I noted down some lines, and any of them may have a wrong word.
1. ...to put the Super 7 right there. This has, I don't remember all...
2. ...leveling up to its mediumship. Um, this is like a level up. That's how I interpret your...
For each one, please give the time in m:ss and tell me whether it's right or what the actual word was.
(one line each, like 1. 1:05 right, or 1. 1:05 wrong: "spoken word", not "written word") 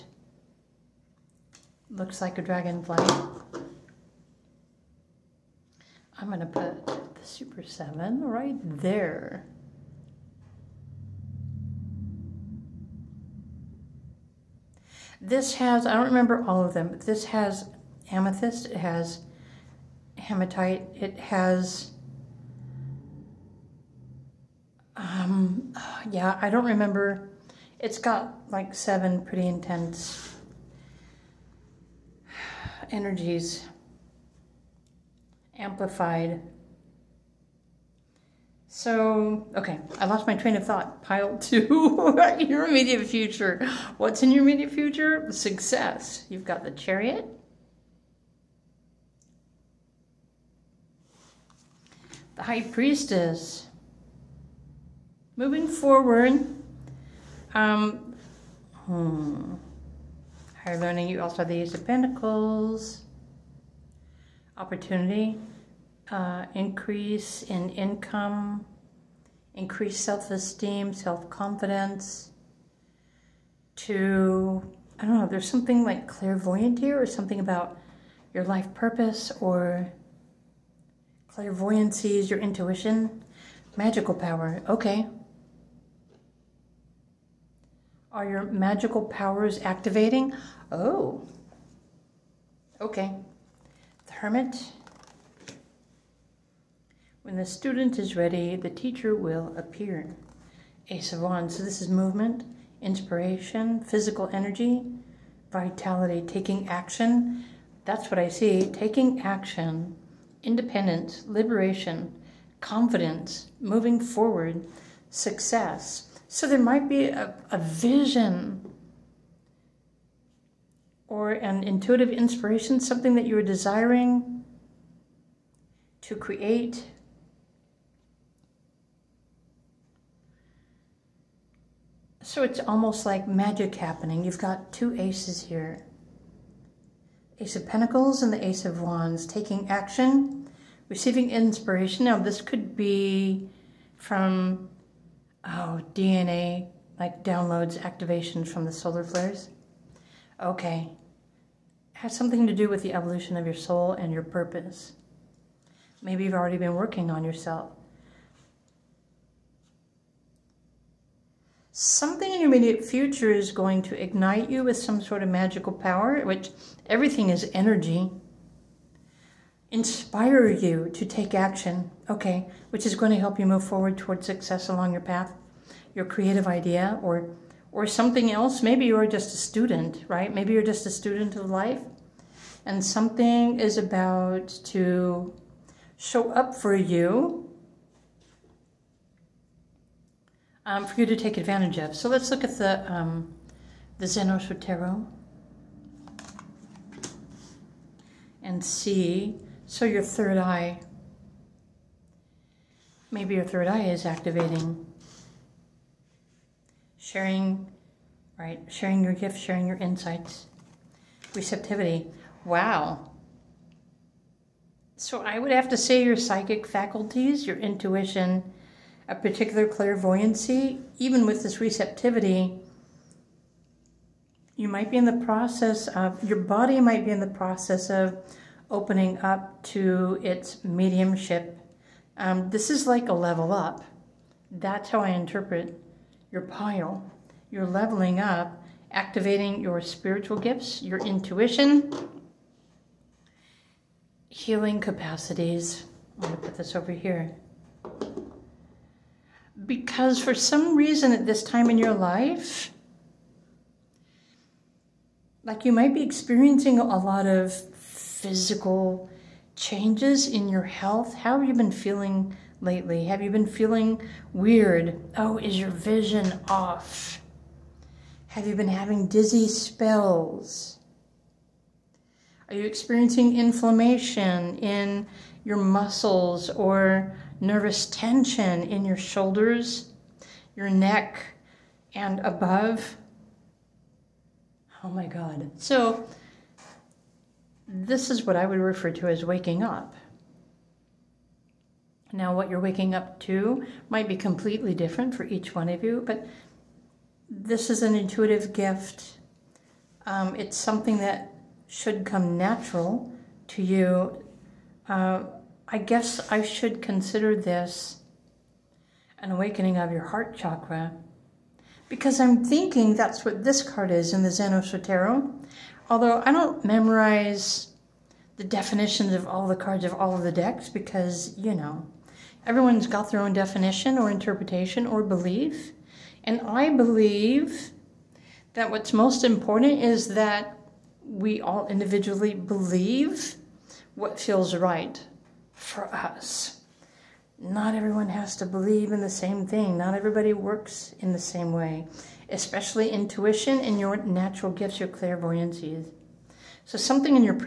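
1. 0:06 right
2. 3:48 wrong: "opening", not "leveling".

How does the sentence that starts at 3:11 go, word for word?
So let's look at the, um, the Zenos and see.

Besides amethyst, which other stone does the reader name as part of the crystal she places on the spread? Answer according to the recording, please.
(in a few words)
Hematite.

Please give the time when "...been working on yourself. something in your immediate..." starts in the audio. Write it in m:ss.
2:36.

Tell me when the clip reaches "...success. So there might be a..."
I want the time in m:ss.
1:55.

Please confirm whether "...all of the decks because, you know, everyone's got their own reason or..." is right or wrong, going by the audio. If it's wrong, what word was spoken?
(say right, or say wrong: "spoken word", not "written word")
wrong: "definition", not "reason".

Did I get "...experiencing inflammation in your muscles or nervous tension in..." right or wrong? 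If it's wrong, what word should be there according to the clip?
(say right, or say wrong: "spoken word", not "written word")
right.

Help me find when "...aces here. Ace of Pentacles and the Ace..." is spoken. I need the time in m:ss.
2:14.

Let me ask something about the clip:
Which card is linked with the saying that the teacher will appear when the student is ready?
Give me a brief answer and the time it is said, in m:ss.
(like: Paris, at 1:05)
The Hermit, at 1:34.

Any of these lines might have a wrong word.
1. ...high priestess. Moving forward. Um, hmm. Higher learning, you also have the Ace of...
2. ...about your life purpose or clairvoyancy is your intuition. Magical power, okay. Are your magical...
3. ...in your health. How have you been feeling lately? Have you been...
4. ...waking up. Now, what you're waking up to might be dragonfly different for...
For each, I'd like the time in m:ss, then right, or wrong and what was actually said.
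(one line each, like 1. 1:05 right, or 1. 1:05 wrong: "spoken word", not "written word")
1. 0:52 right
2. 1:17 right
3. 4:20 right
4. 4:49 wrong: "completely", not "dragonfly".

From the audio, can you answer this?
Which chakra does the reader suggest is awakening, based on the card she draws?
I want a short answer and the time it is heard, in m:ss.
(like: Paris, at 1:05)
Heart chakra, at 5:10.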